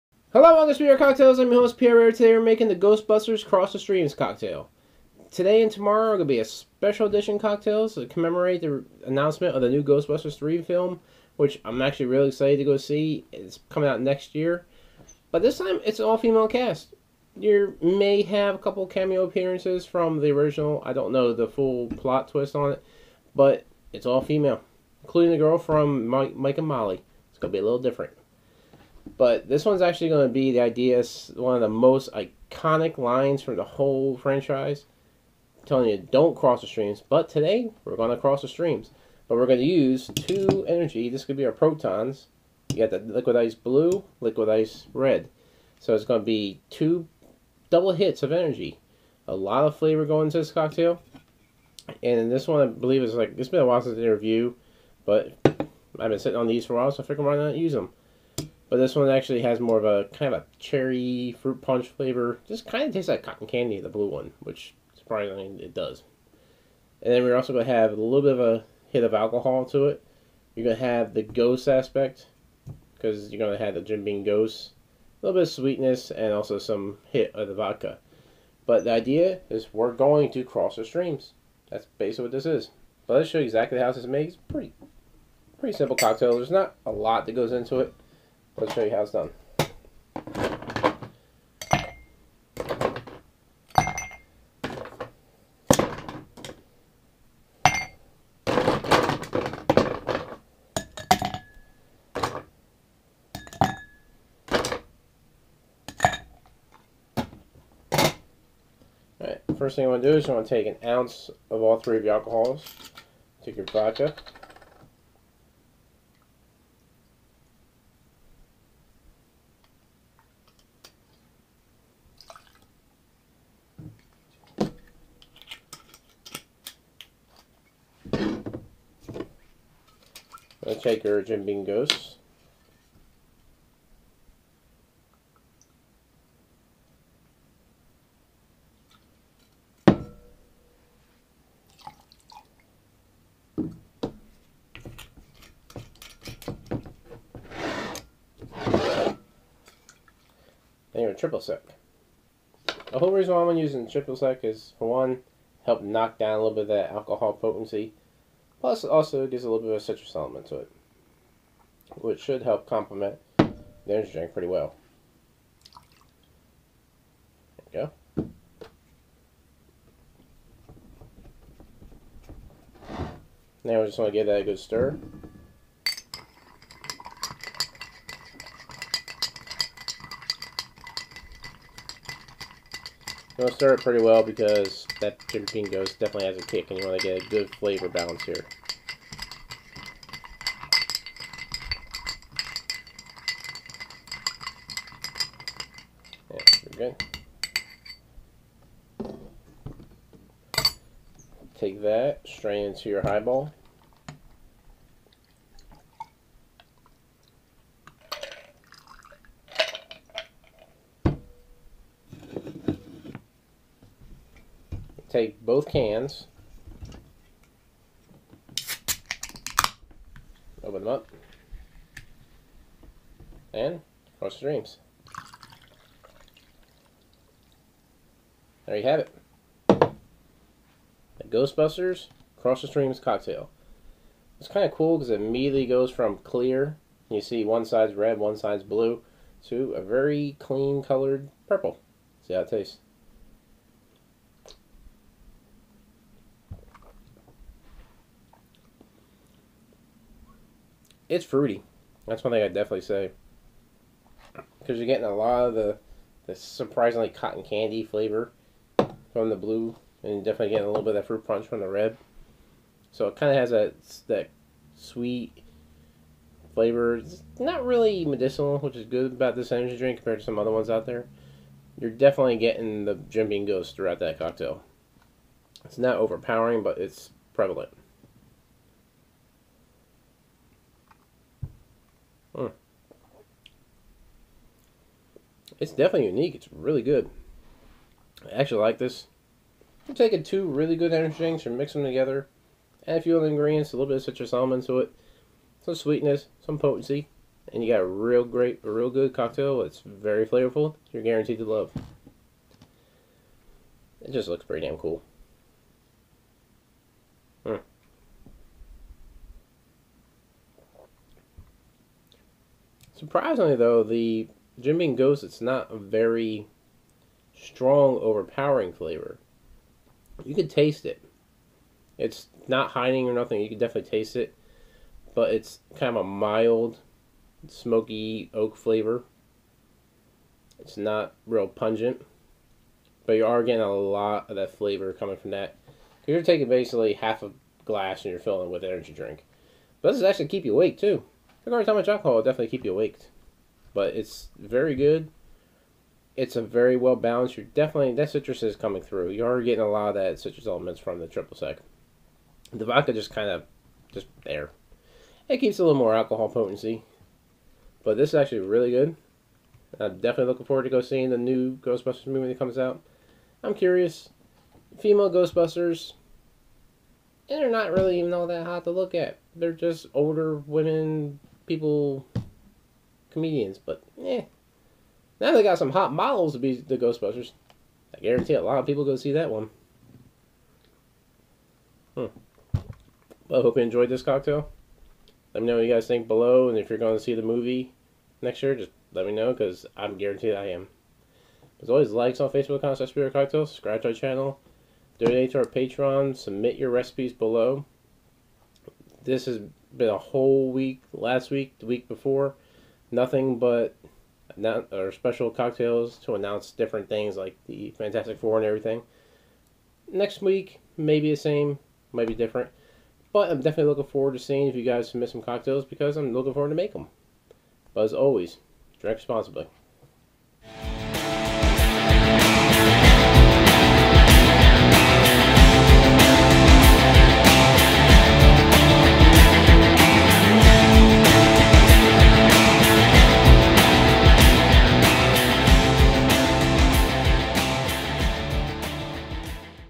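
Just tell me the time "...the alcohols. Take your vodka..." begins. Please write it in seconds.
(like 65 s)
112 s.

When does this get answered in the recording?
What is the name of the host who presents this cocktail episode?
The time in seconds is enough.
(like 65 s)
1 s.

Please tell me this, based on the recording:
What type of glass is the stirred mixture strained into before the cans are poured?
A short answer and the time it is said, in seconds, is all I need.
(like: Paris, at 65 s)
Highball, at 203 s.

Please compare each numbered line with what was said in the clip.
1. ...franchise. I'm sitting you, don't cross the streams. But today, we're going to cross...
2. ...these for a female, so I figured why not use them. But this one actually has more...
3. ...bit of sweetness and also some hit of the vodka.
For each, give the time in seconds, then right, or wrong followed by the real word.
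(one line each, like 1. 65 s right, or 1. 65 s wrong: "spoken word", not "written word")
1. 34 s wrong: "telling", not "sitting"
2. 56 s wrong: "while", not "female"
3. 75 s right.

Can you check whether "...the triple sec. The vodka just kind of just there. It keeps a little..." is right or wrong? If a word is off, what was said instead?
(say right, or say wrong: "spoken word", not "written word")
right.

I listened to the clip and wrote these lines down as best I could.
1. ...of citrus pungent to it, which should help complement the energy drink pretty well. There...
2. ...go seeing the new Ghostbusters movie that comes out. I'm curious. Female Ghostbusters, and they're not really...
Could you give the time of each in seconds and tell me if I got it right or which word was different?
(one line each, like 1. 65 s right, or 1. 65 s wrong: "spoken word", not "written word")
1. 159 s wrong: "element", not "pungent"
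2. 360 s right.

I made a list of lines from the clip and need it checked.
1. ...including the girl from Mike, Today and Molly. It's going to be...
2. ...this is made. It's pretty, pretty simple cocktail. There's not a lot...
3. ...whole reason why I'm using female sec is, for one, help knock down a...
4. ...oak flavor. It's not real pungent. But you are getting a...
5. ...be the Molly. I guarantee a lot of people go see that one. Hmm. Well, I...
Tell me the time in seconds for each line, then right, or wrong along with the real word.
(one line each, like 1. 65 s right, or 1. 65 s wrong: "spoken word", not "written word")
1. 25 s wrong: "Mike", not "Today"
2. 83 s right
3. 152 s wrong: "triple", not "female"
4. 328 s right
5. 376 s wrong: "Ghostbusters", not "Molly".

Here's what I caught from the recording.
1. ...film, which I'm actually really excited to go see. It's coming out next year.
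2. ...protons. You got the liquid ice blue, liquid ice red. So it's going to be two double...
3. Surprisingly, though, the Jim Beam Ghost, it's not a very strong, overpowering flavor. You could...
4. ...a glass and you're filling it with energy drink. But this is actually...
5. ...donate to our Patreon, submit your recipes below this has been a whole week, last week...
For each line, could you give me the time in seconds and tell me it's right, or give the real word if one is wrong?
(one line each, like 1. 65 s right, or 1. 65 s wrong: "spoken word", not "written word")
1. 10 s right
2. 41 s right
3. 313 s right
4. 337 s right
5. 394 s right.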